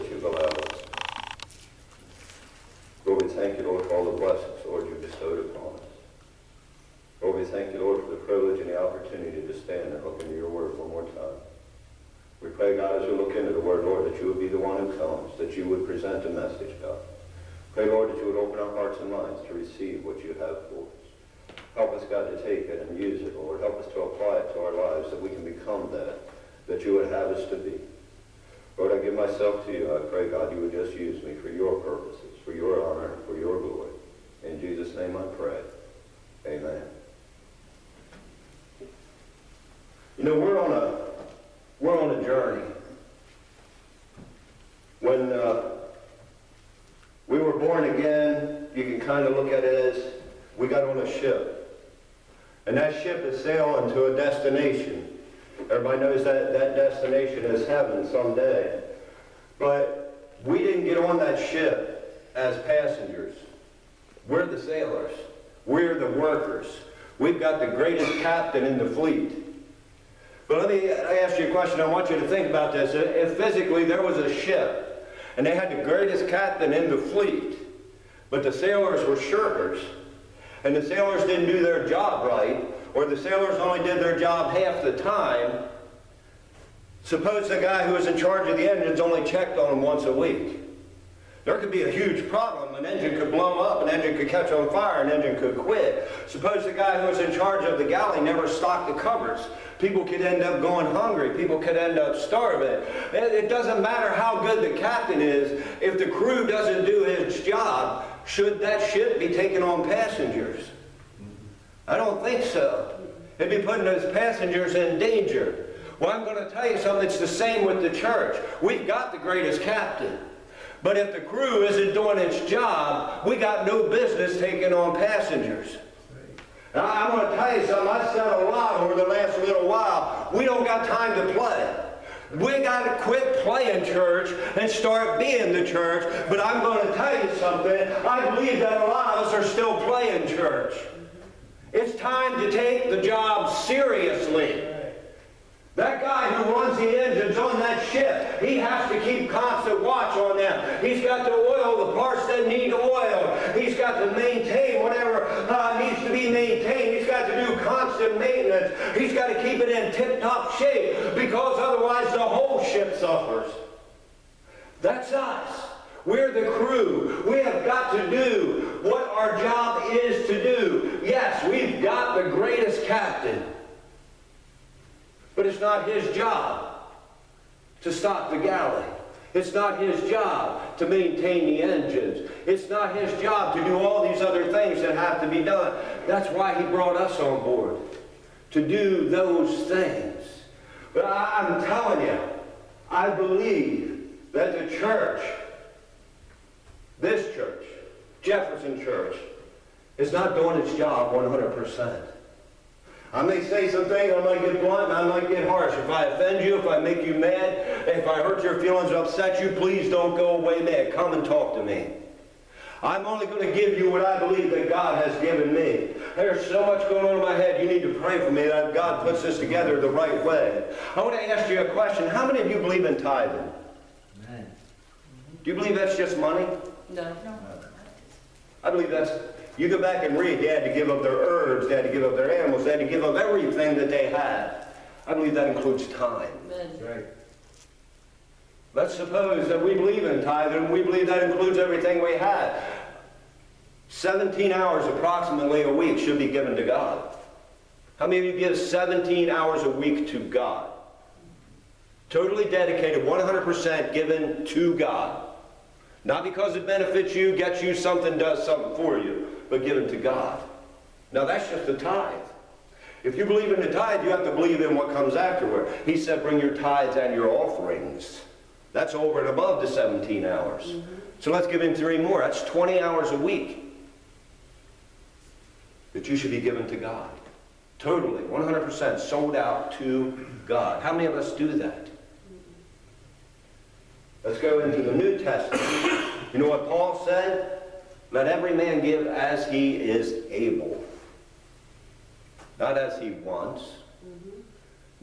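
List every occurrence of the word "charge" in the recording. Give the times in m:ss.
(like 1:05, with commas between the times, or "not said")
1:28, 1:37.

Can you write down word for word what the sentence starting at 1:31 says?
There could be a huge problem.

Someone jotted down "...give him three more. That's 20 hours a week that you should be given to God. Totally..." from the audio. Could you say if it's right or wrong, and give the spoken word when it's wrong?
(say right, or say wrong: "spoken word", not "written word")
right.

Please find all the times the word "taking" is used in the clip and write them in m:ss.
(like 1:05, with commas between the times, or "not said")
1:49, 2:04.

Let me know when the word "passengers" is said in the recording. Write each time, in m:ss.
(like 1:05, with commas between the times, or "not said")
1:02, 1:49, 1:54, 2:04.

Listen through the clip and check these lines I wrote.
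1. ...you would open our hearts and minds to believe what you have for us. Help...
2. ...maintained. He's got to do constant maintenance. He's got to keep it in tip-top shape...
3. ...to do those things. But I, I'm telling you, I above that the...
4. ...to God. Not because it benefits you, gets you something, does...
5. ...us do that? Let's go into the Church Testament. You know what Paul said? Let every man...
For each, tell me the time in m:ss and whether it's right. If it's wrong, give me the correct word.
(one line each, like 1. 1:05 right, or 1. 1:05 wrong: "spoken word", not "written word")
1. 0:18 wrong: "receive", not "believe"
2. 2:36 right
3. 3:08 wrong: "believe", not "above"
4. 4:14 right
5. 4:41 wrong: "New", not "Church".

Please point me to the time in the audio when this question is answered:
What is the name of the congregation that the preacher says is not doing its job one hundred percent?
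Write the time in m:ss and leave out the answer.
3:18.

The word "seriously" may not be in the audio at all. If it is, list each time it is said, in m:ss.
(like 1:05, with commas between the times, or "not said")
2:23.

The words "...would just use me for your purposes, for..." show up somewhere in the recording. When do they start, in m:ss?
0:30.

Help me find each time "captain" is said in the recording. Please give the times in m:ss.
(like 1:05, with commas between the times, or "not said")
1:08, 1:16, 1:44, 1:59, 2:52.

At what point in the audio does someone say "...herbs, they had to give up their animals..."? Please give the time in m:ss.
3:51.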